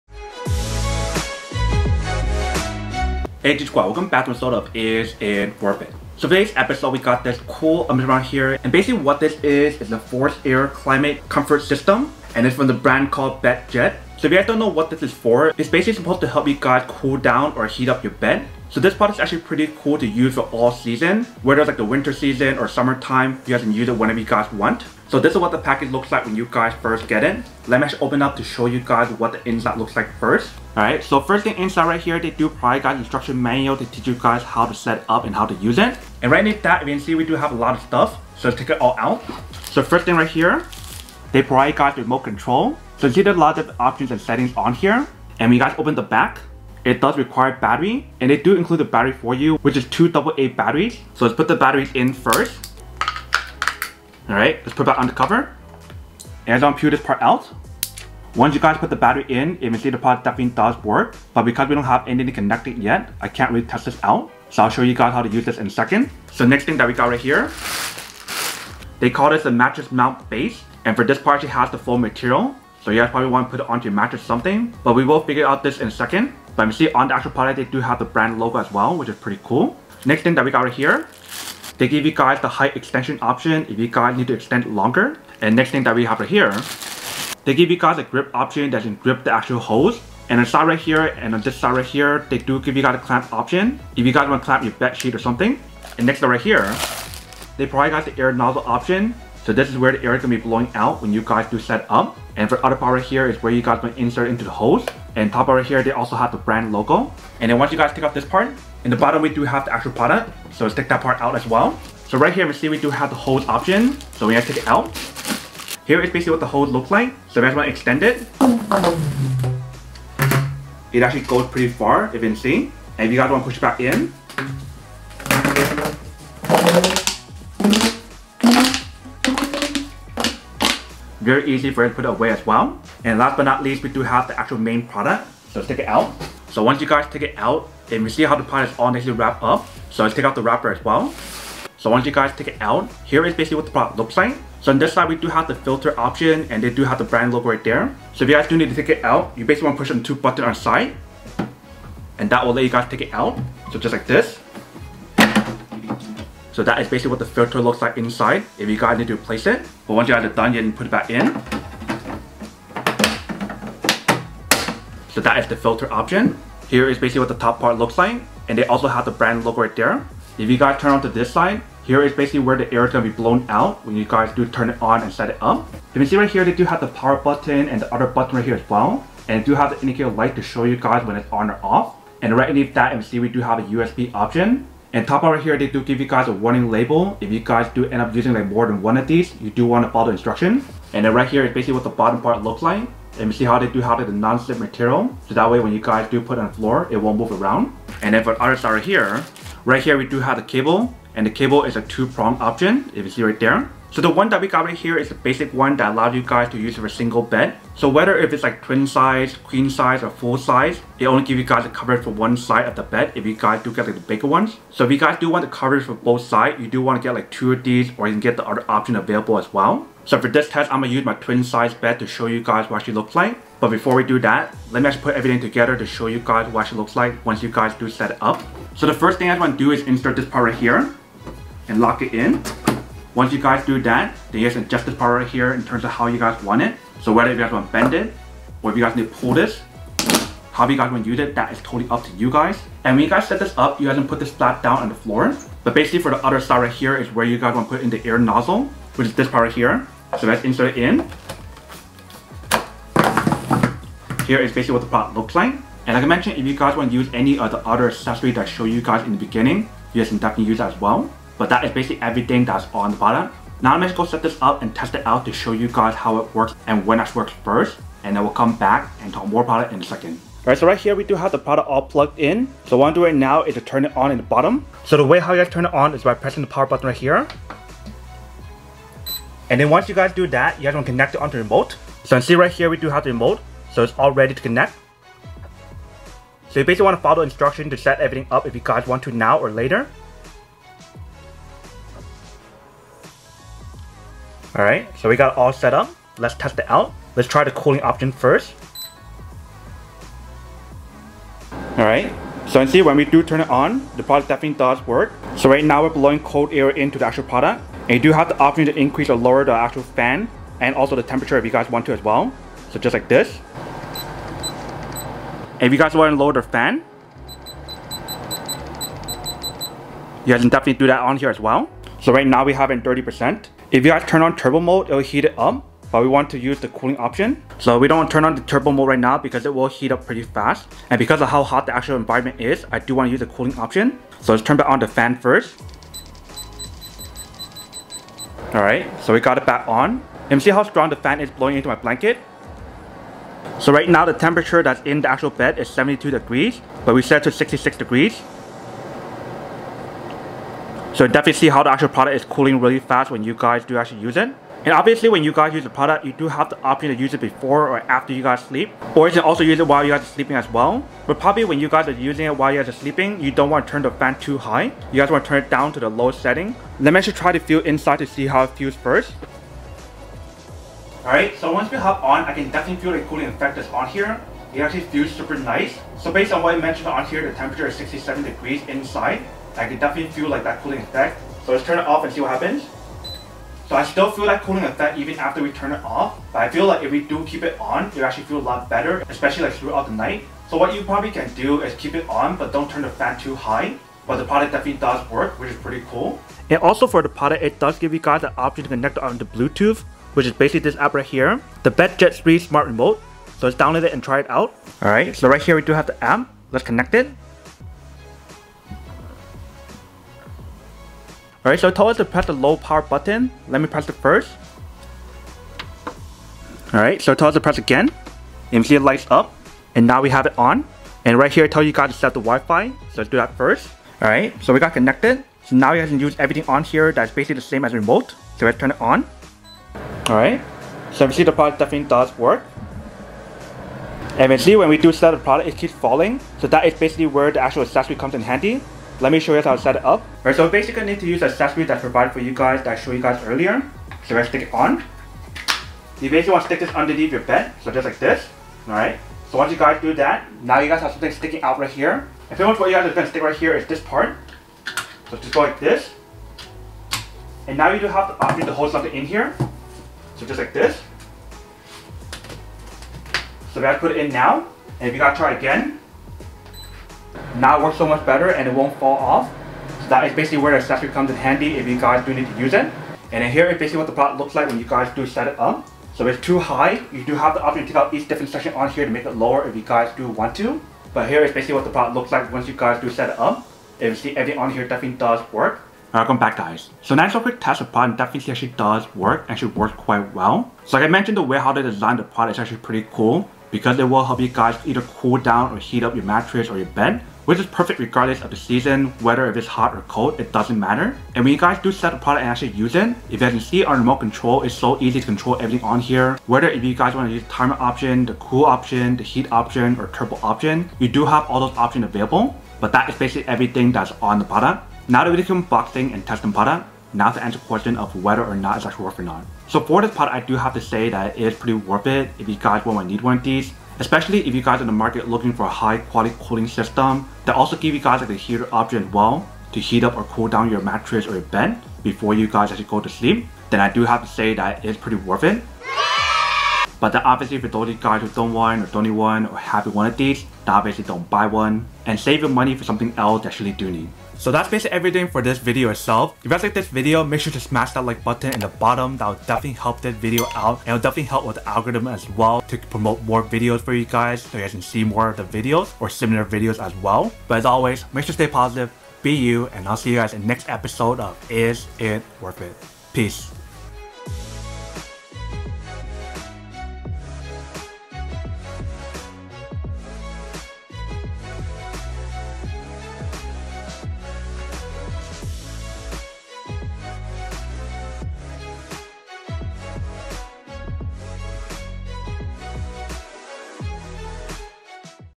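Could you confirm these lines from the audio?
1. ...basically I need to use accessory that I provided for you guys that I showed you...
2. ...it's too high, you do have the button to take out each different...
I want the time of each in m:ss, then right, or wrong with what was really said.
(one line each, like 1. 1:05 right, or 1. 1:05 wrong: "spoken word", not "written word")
1. 7:20 right
2. 7:56 wrong: "option", not "button".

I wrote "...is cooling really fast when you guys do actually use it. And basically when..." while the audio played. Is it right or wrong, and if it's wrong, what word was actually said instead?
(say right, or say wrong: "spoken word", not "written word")
wrong: "obviously", not "basically".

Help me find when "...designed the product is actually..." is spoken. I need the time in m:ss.
8:11.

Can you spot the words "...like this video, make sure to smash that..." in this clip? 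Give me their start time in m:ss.
9:06.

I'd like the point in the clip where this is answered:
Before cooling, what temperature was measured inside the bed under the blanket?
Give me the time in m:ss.
5:45.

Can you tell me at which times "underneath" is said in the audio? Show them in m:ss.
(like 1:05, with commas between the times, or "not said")
0:36, 3:02, 7:26.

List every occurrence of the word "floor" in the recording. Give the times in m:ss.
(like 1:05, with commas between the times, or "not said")
3:16, 4:04.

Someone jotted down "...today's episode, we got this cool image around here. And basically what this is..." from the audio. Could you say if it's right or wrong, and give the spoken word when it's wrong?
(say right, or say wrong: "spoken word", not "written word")
right.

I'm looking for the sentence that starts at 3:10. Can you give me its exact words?
And then right here is basically what the bottom part looks like.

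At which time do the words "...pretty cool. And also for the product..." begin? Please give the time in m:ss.
6:35.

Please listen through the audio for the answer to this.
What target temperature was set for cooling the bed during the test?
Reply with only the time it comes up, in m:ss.
5:47.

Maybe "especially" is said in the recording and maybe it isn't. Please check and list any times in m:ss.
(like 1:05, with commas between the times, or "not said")
6:29, 8:43.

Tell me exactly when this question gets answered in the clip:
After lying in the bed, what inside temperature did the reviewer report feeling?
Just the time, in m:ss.
6:17.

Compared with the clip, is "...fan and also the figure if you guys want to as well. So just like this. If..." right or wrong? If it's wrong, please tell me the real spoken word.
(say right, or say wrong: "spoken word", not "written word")
wrong: "temperature", not "figure".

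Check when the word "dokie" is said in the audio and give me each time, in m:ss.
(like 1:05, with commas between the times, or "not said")
not said.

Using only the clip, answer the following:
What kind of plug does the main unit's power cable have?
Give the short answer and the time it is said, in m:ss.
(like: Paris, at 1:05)
two-prong, at 3:21.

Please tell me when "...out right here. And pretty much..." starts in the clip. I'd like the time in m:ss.
7:31.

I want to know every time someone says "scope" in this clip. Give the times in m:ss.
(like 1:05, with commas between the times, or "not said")
not said.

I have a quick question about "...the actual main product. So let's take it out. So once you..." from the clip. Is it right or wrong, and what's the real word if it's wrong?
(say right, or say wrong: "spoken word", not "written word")
right.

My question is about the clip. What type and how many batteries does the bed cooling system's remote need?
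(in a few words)
2 AA batteries.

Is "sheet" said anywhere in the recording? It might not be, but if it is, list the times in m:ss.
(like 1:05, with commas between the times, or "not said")
1:34.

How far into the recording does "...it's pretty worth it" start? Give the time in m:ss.
8:54.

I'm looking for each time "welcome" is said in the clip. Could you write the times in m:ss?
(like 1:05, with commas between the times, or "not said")
0:03, 8:05.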